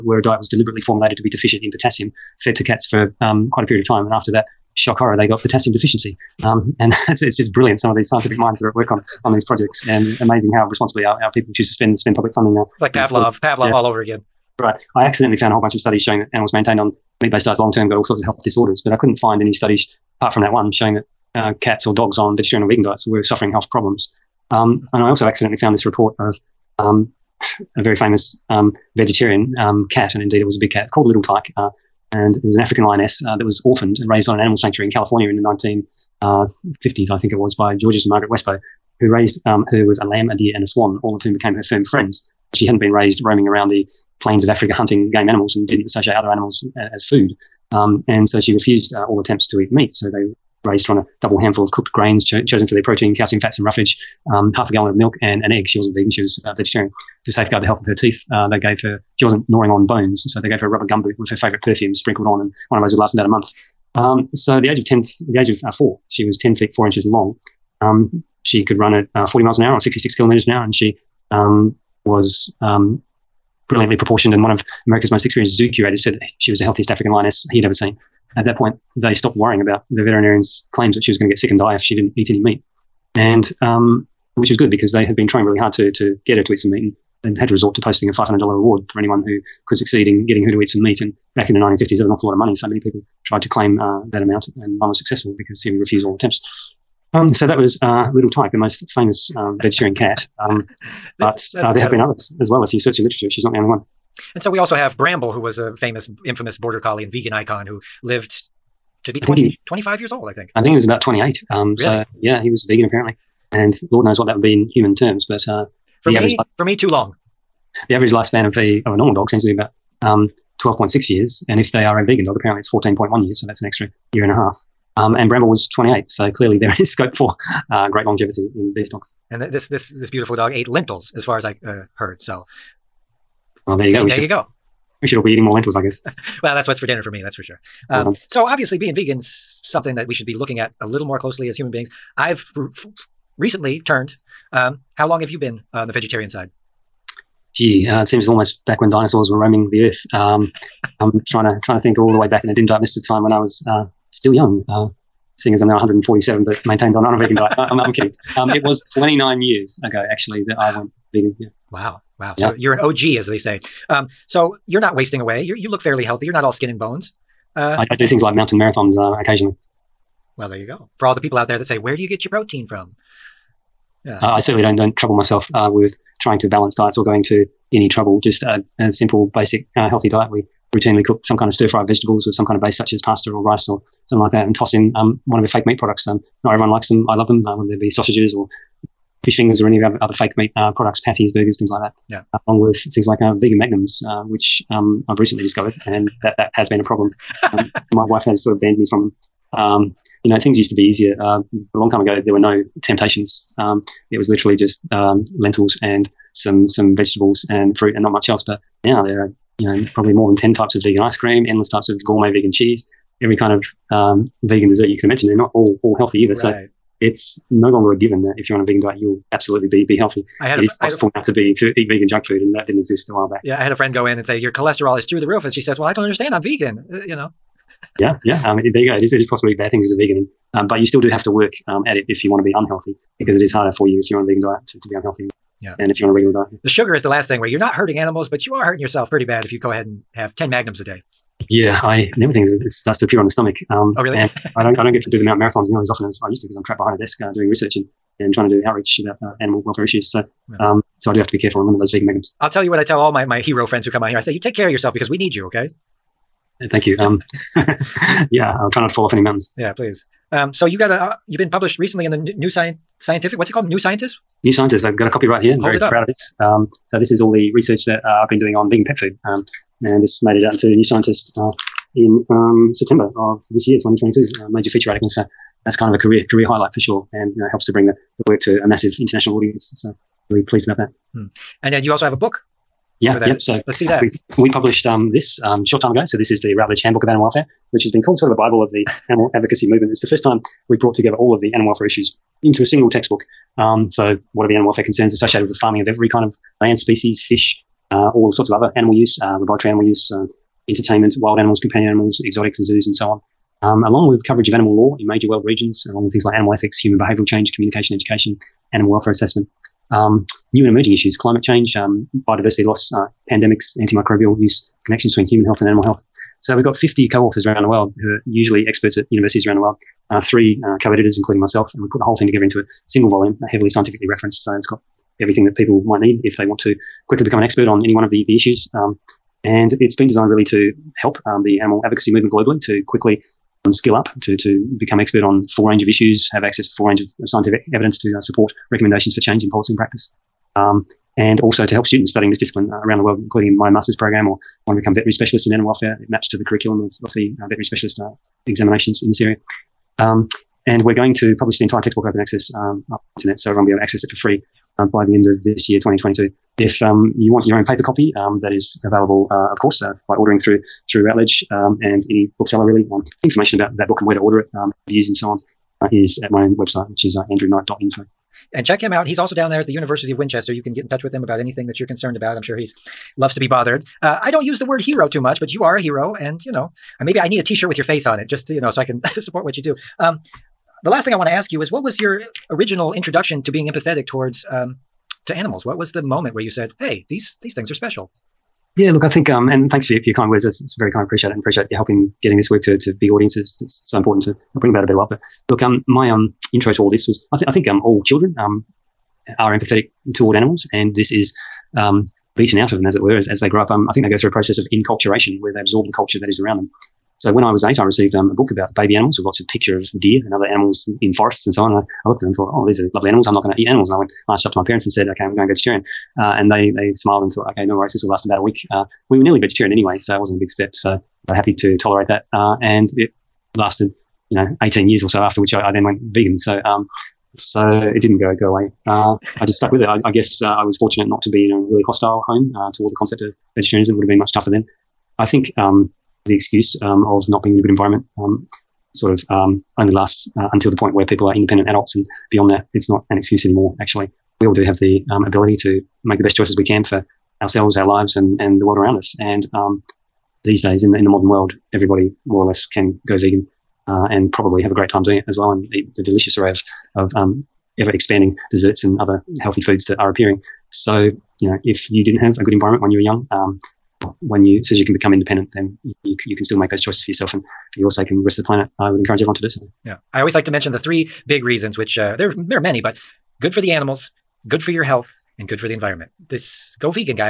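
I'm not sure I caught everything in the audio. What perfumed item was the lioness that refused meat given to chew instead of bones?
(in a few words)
Rubber gumboot.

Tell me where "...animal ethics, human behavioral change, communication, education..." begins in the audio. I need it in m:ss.
5:06.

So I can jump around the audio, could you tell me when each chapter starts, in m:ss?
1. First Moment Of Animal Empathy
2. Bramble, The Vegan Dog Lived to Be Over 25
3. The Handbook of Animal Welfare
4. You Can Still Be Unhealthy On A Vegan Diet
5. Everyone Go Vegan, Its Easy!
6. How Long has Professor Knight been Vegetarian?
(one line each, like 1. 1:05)
1. 6:07
2. 1:45
3. 4:15
4. 3:37
5. 7:22
6. 2:22.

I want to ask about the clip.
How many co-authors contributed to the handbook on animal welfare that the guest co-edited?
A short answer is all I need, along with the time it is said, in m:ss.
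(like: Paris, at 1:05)
50, at 5:16.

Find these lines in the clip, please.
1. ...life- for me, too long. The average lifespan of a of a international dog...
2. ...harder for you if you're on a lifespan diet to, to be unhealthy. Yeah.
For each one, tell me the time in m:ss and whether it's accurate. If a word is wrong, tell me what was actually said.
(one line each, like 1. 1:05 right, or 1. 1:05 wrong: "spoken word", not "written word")
1. 1:56 wrong: "normal", not "international"
2. 3:53 wrong: "vegan", not "lifespan".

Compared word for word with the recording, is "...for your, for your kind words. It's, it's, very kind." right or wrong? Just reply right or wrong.
right.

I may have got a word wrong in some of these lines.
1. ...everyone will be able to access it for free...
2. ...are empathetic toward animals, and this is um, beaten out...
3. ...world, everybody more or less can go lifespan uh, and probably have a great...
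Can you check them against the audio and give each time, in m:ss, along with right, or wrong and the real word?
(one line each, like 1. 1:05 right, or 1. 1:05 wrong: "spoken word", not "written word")
1. 5:53 right
2. 6:39 right
3. 7:31 wrong: "vegan", not "lifespan".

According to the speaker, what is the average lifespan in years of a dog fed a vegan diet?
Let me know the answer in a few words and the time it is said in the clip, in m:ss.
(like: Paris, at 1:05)
14.1 years, at 2:02.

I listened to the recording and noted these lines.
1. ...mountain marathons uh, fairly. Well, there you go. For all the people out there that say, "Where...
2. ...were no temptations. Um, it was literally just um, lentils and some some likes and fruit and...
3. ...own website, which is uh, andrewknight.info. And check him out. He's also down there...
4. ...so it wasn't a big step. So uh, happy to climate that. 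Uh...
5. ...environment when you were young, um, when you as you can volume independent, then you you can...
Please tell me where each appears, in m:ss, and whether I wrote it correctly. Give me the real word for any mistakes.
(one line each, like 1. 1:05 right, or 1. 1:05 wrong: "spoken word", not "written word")
1. 2:48 wrong: "occasionally", not "fairly"
2. 3:22 wrong: "vegetables", not "likes"
3. 6:06 right
4. 6:59 wrong: "tolerate", not "climate"
5. 7:42 wrong: "become", not "volume".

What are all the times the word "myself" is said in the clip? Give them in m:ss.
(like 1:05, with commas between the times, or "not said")
2:55, 5:21.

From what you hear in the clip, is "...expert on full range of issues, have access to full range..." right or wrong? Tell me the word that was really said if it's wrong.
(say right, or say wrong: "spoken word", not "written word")
right.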